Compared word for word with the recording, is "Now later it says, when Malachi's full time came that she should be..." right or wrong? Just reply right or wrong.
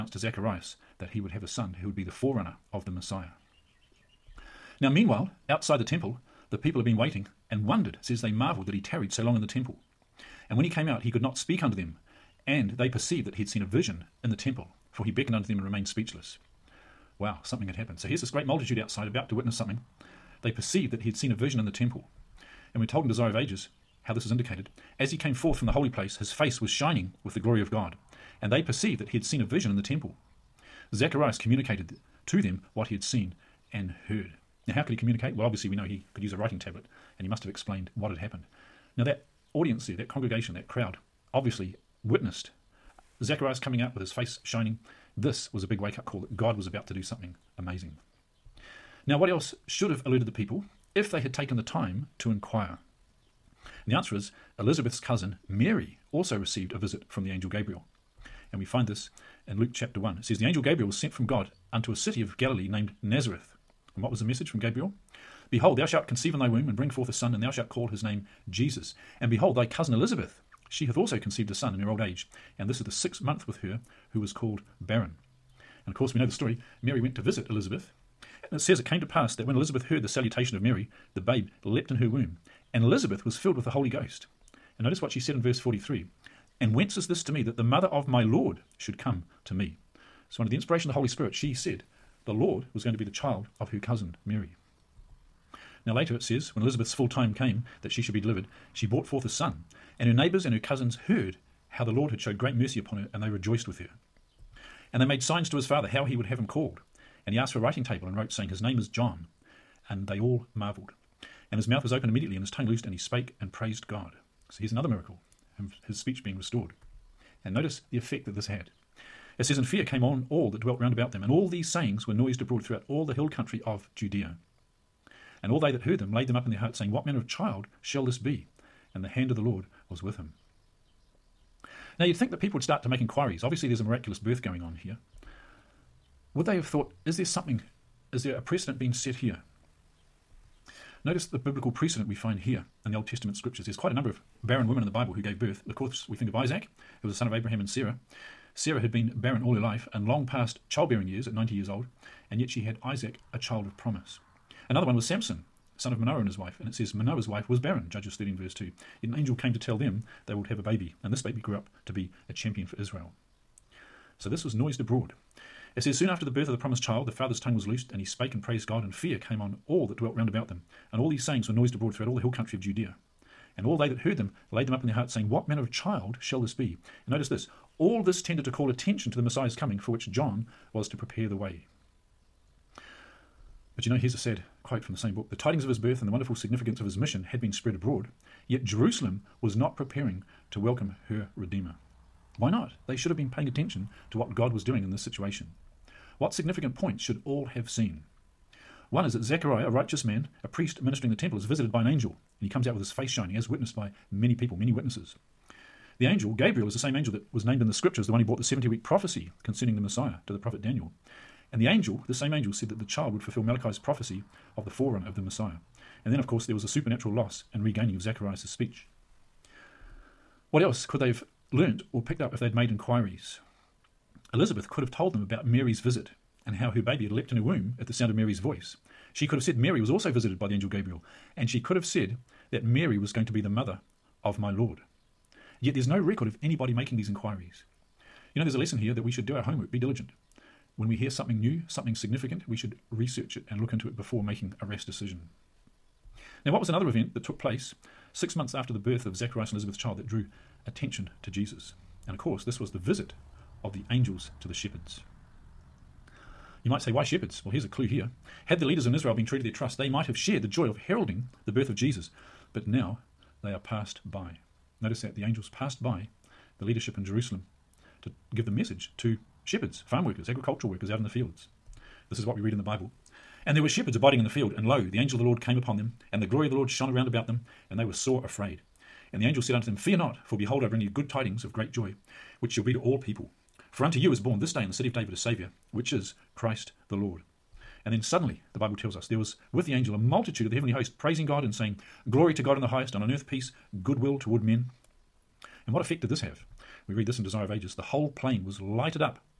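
wrong.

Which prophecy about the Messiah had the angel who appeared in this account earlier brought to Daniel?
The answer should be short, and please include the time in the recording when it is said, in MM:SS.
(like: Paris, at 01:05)
70 week prophecy, at 03:28.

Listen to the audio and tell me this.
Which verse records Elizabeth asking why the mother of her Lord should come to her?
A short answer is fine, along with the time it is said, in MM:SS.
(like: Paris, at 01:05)
Verse 43, at 01:25.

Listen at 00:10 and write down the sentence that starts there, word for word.
And when he came out, he could not speak unto them.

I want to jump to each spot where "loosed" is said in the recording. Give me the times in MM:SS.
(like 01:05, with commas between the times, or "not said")
01:52, 02:47.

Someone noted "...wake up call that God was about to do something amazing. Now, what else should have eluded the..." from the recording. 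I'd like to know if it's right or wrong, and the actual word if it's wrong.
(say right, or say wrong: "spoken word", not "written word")
right.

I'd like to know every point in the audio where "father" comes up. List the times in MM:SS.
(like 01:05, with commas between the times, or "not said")
01:45, 02:47.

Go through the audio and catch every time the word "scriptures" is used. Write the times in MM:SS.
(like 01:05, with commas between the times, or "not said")
02:23, 03:27.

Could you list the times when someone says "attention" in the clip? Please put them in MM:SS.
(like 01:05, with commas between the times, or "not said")
02:58, 03:13, 04:10.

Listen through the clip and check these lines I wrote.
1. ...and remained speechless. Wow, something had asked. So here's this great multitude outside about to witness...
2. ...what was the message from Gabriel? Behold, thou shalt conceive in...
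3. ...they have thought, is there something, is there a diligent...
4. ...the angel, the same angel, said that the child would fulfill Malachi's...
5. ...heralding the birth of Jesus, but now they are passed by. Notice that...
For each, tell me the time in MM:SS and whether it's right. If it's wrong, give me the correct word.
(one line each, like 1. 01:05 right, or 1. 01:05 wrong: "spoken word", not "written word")
1. 00:15 wrong: "happened", not "asked"
2. 01:04 right
3. 02:16 wrong: "precedent", not "diligent"
4. 03:31 right
5. 04:20 right.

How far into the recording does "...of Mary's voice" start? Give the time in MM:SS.
03:48.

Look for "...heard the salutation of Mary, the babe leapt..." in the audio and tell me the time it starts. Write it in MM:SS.
01:19.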